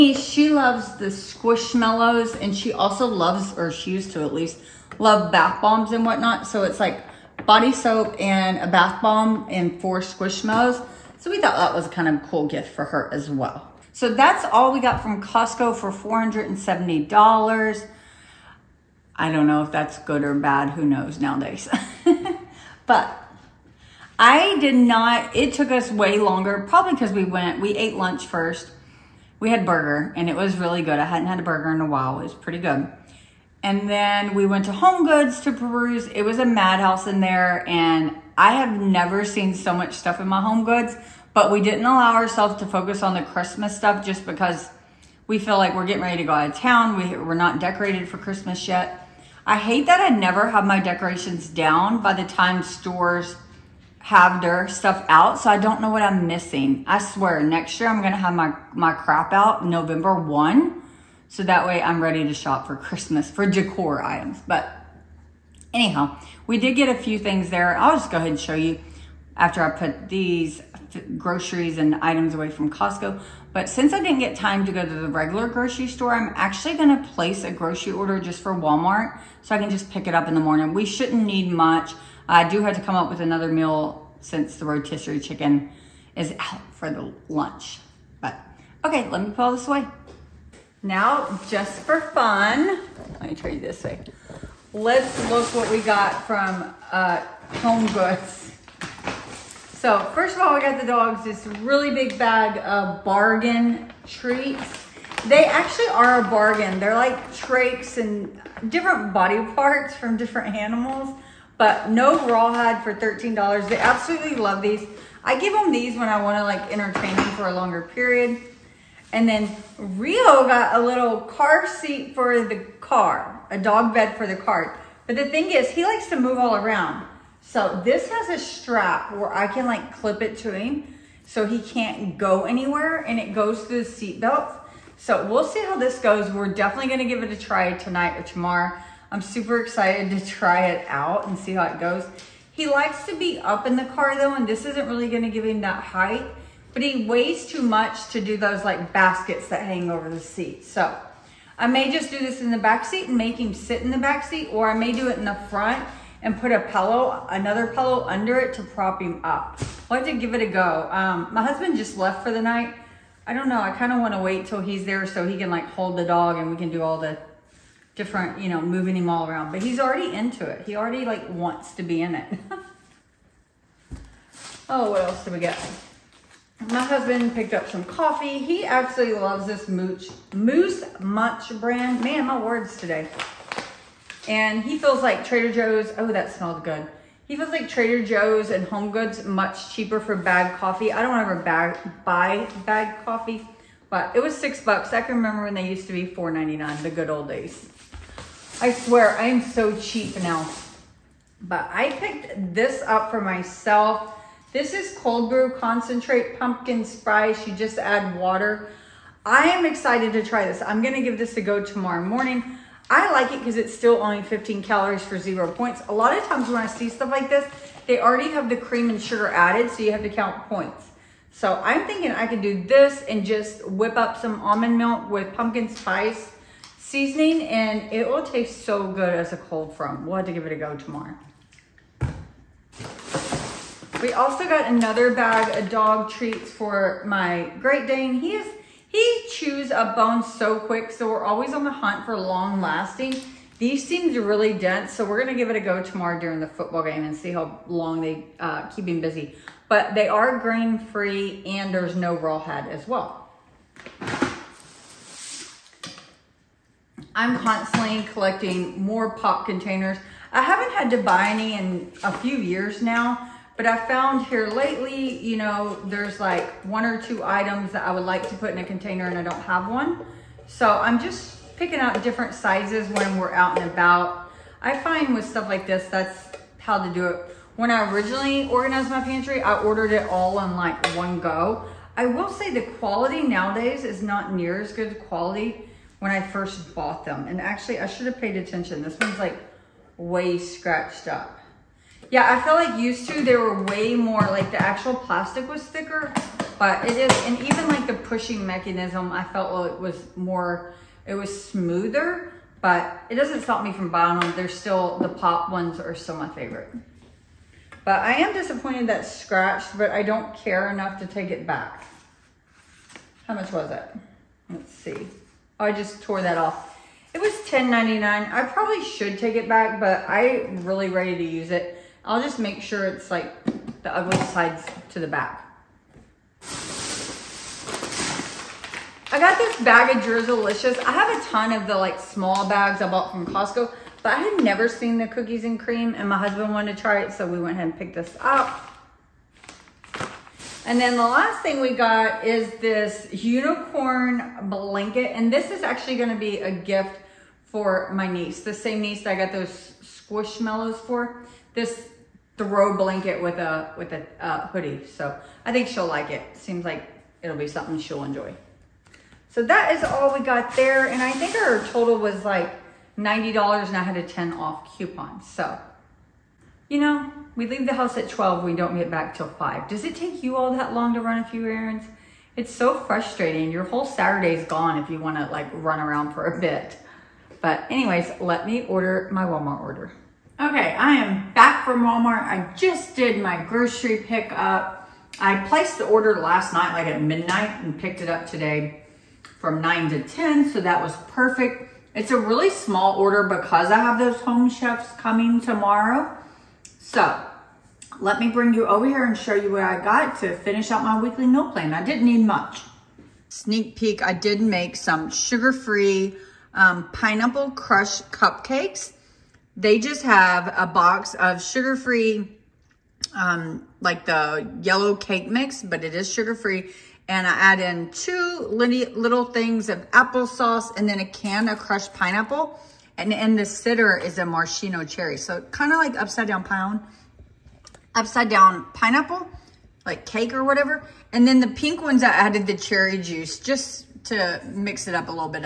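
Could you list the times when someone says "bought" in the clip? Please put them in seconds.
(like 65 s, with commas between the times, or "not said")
286 s, 332 s.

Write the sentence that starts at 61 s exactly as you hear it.
So that way I'm ready to shop for Christmas for decor items.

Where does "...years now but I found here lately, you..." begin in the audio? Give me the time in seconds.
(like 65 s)
262 s.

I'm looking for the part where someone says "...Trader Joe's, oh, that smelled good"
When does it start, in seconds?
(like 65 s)
185 s.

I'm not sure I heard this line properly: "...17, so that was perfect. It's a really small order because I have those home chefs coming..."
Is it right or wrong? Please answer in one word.
wrong.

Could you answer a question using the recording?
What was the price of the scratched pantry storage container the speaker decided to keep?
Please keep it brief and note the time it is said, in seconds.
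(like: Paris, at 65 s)
$10.99, at 317 s.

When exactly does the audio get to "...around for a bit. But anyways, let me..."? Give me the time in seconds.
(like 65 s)
375 s.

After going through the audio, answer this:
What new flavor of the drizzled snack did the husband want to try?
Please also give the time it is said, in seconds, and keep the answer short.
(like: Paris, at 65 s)
cookies and cream, at 335 s.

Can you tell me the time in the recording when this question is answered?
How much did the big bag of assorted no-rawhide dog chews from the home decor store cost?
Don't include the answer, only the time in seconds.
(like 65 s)
112 s.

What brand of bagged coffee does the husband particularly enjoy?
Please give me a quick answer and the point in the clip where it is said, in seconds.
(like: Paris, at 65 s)
Moose Munch, at 180 s.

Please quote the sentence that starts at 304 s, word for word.
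They're still, the pop ones are still my favorite.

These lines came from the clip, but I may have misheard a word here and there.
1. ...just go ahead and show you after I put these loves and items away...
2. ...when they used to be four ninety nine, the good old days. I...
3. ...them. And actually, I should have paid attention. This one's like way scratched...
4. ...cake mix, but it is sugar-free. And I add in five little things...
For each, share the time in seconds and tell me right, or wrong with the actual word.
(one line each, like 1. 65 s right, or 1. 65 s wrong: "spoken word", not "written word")
1. 67 s wrong: "groceries", not "loves"
2. 195 s right
3. 287 s right
4. 414 s wrong: "two", not "five".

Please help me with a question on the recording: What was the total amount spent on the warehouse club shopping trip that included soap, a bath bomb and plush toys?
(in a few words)
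$470.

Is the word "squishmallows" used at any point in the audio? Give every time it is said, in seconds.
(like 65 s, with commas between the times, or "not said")
1 s, 10 s, 349 s.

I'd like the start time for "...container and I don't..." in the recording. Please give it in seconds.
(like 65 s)
268 s.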